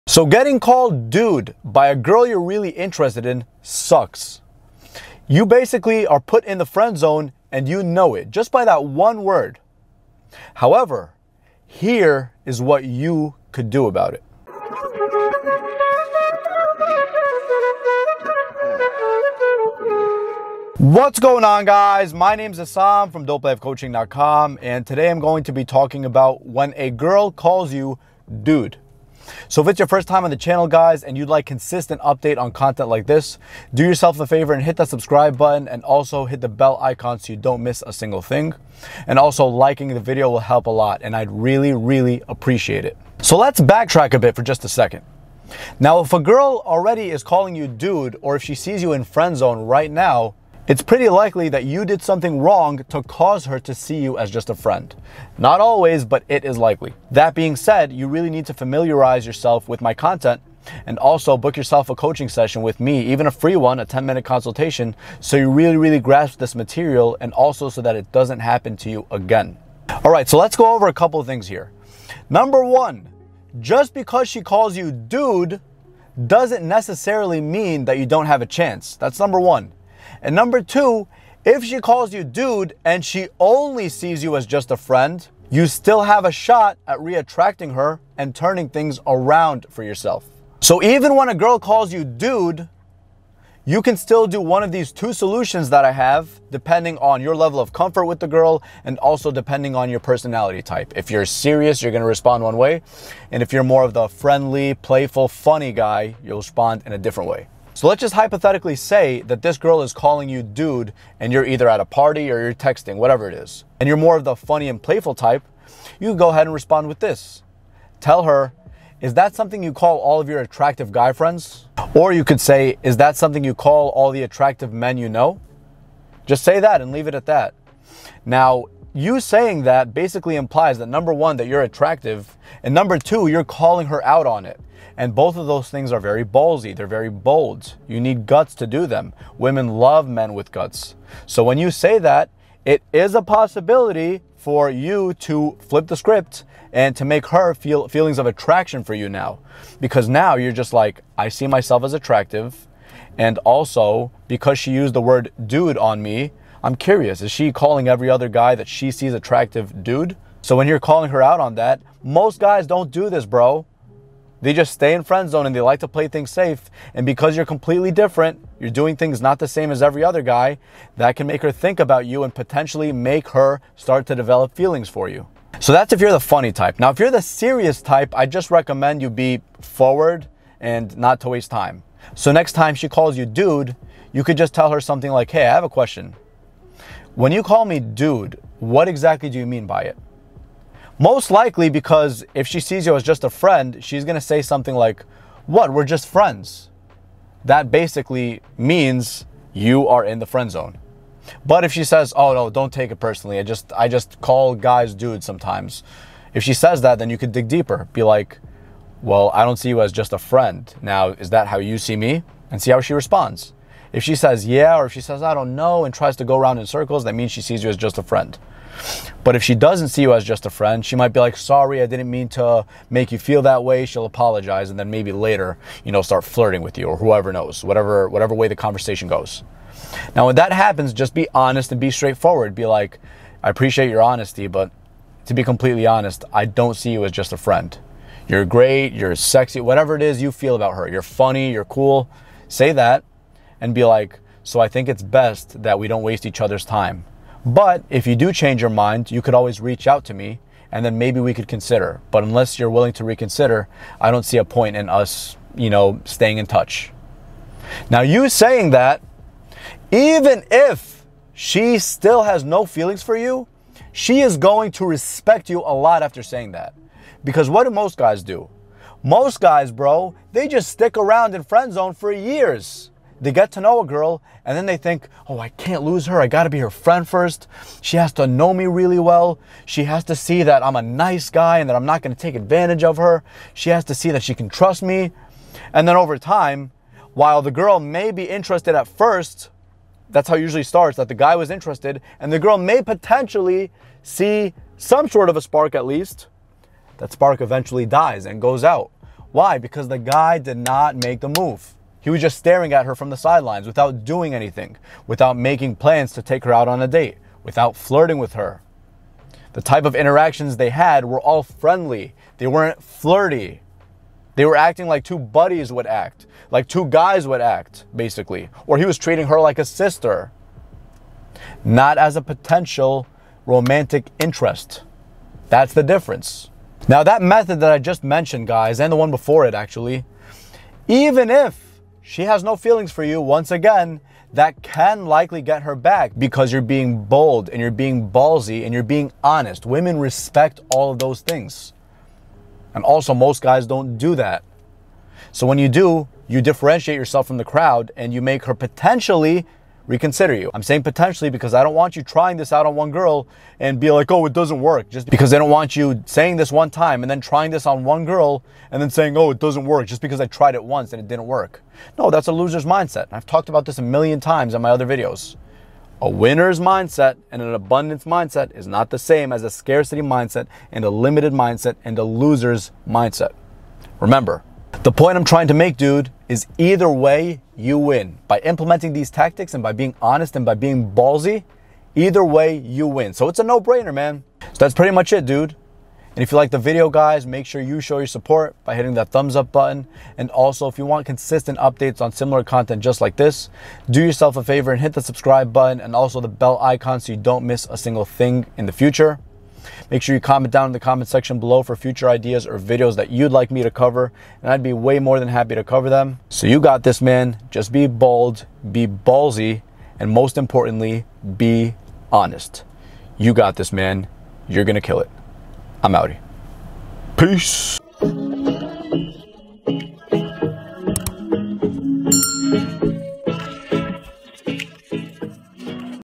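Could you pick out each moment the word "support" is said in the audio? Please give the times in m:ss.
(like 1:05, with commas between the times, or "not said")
6:28.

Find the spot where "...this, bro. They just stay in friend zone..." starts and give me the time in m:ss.
2:43.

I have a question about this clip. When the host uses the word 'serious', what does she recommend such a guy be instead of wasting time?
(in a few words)
forward.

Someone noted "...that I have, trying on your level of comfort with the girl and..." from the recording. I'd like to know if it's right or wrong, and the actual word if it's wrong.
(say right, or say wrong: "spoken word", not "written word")
wrong: "depending", not "trying".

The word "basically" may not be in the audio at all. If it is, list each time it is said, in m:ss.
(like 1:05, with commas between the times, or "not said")
0:05, 2:09, 3:17, 5:17.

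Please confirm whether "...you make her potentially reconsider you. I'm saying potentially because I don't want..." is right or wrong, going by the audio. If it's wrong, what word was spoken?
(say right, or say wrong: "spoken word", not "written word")
right.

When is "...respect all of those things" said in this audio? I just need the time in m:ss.
5:39.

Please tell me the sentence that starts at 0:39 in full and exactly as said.
And also liking the video will help a lot and I'd really, really appreciate it.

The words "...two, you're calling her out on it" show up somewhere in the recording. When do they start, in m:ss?
2:12.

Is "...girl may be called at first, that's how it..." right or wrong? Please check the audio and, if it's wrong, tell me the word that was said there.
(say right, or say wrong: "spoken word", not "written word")
wrong: "interested", not "called".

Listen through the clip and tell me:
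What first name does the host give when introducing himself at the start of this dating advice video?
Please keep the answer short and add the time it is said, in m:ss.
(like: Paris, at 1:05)
Assam, at 0:22.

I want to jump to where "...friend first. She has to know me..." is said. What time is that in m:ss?
4:36.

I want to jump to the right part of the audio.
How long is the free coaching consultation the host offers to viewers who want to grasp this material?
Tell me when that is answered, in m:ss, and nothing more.
1:03.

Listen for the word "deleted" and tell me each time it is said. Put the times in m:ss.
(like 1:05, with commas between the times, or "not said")
not said.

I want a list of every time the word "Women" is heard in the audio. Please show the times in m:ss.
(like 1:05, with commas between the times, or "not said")
2:19, 5:39.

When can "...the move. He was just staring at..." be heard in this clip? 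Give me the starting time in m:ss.
5:01.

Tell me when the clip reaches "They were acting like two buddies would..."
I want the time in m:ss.
5:14.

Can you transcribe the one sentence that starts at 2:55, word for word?
So that's if you're the funny type.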